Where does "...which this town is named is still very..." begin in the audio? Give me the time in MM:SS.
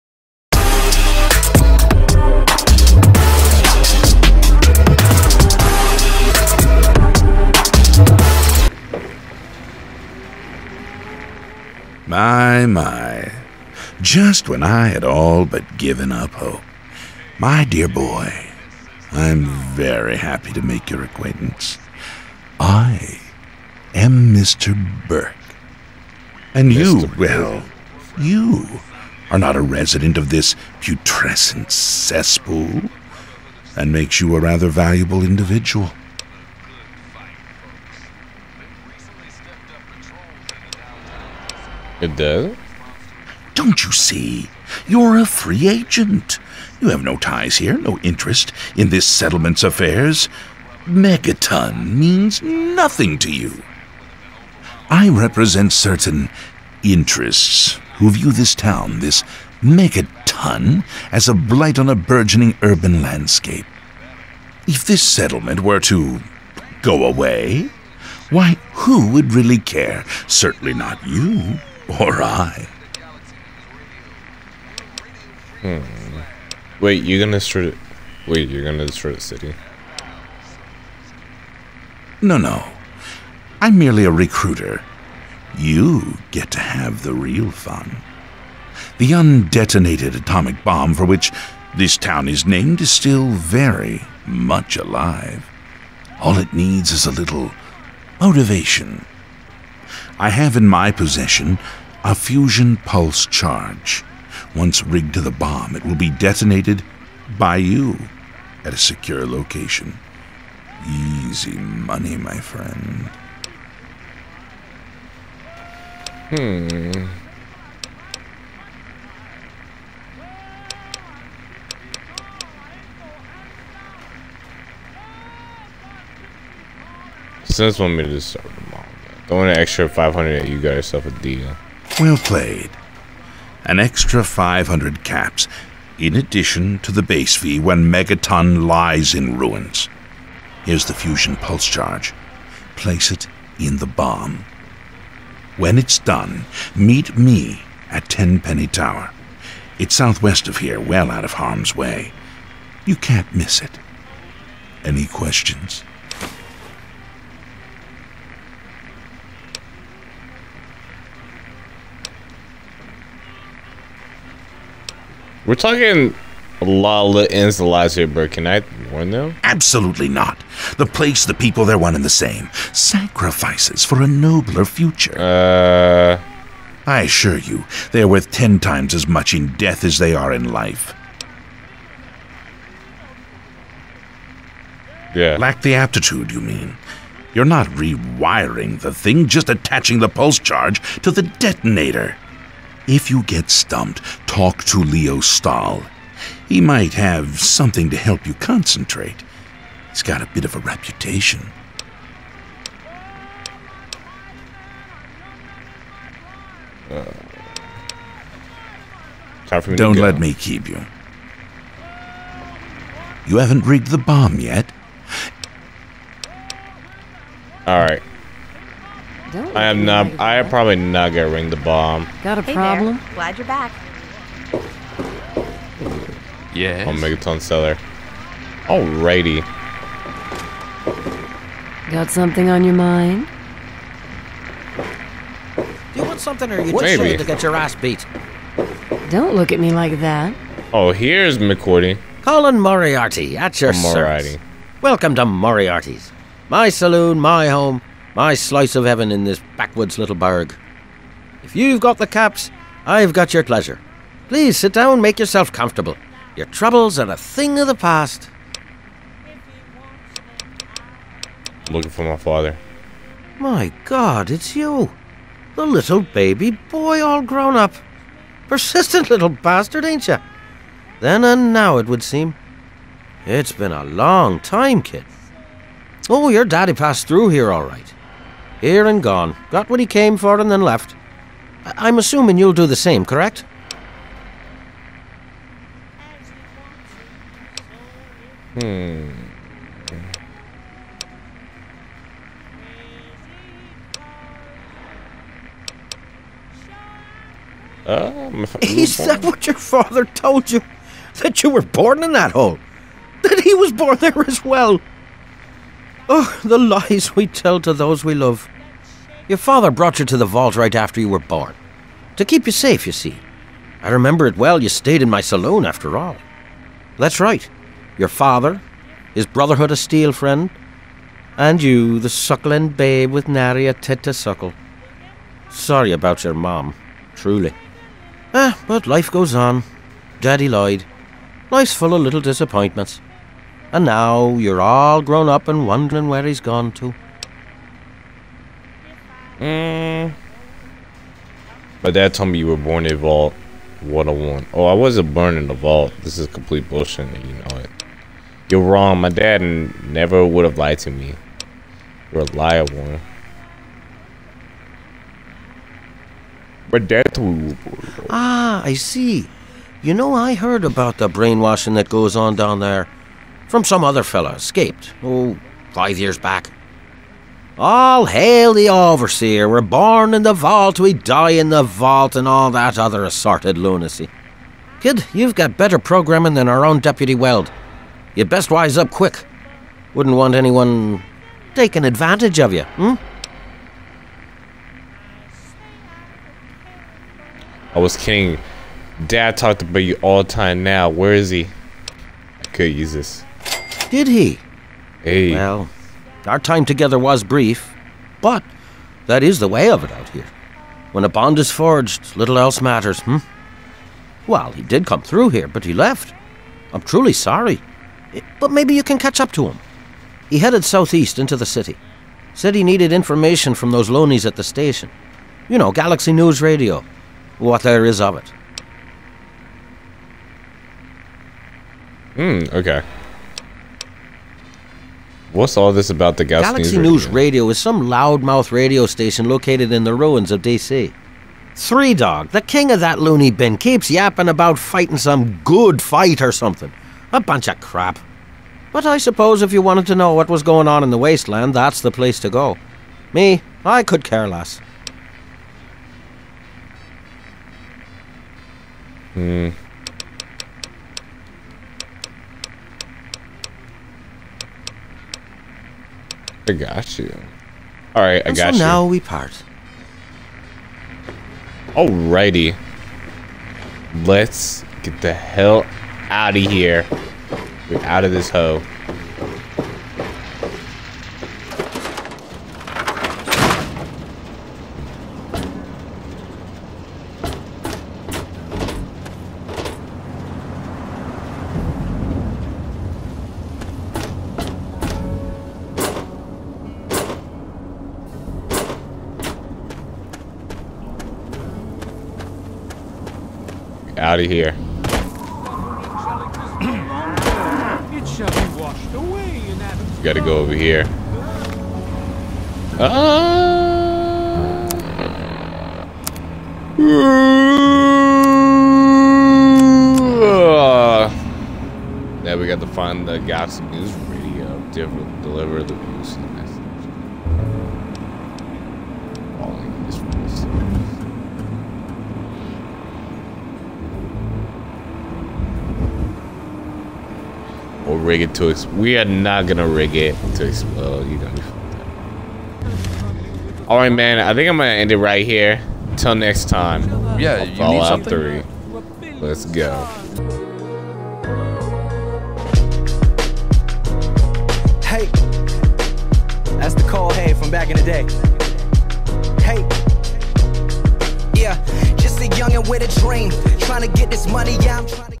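01:31.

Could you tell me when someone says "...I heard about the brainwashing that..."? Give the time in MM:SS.
06:00.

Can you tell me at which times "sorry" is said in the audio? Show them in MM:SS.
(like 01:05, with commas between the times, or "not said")
05:25, 06:47.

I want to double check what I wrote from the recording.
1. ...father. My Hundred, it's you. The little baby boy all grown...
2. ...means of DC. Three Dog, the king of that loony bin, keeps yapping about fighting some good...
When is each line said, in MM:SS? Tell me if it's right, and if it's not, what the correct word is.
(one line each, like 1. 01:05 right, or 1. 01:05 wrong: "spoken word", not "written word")
1. 04:22 wrong: "God", not "Hundred"
2. 07:09 wrong: "ruins", not "means".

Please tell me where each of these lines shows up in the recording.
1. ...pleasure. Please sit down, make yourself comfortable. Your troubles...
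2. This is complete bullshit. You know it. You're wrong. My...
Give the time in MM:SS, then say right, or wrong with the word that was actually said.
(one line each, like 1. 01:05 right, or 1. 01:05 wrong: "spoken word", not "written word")
1. 04:13 right
2. 05:46 right.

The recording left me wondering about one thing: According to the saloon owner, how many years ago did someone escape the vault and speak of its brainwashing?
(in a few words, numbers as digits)
5.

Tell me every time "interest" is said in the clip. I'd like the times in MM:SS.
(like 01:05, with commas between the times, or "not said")
00:47, 00:56.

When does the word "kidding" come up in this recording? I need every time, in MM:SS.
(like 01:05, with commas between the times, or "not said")
06:27.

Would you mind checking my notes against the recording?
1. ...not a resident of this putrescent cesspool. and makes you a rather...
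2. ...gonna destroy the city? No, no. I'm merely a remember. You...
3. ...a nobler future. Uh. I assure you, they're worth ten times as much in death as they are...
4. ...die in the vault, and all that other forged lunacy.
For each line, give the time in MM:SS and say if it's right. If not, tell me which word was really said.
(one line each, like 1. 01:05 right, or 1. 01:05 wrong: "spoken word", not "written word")
1. 00:29 right
2. 01:18 wrong: "recruiter", not "remember"
3. 02:54 right
4. 06:10 wrong: "assorted", not "forged".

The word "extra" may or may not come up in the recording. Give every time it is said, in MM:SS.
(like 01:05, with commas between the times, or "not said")
02:09, 02:13.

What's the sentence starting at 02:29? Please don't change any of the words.
It's southwest of here, well out of harm's way.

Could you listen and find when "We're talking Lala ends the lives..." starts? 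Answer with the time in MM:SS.
02:45.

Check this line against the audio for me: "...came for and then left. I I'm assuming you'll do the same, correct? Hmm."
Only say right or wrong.
right.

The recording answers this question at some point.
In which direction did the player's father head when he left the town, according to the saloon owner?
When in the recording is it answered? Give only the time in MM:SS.
06:50.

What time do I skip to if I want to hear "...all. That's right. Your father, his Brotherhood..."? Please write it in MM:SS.
05:15.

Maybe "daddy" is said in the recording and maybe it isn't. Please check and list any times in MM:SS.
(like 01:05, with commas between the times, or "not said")
04:36, 05:30.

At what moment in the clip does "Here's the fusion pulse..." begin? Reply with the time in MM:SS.
02:20.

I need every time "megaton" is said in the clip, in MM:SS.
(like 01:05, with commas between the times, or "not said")
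00:50, 00:59, 02:17, 03:46.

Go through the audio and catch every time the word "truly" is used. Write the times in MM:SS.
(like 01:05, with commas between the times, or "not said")
05:27, 06:46.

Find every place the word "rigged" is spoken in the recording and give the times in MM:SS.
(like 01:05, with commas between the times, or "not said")
01:44, 03:33.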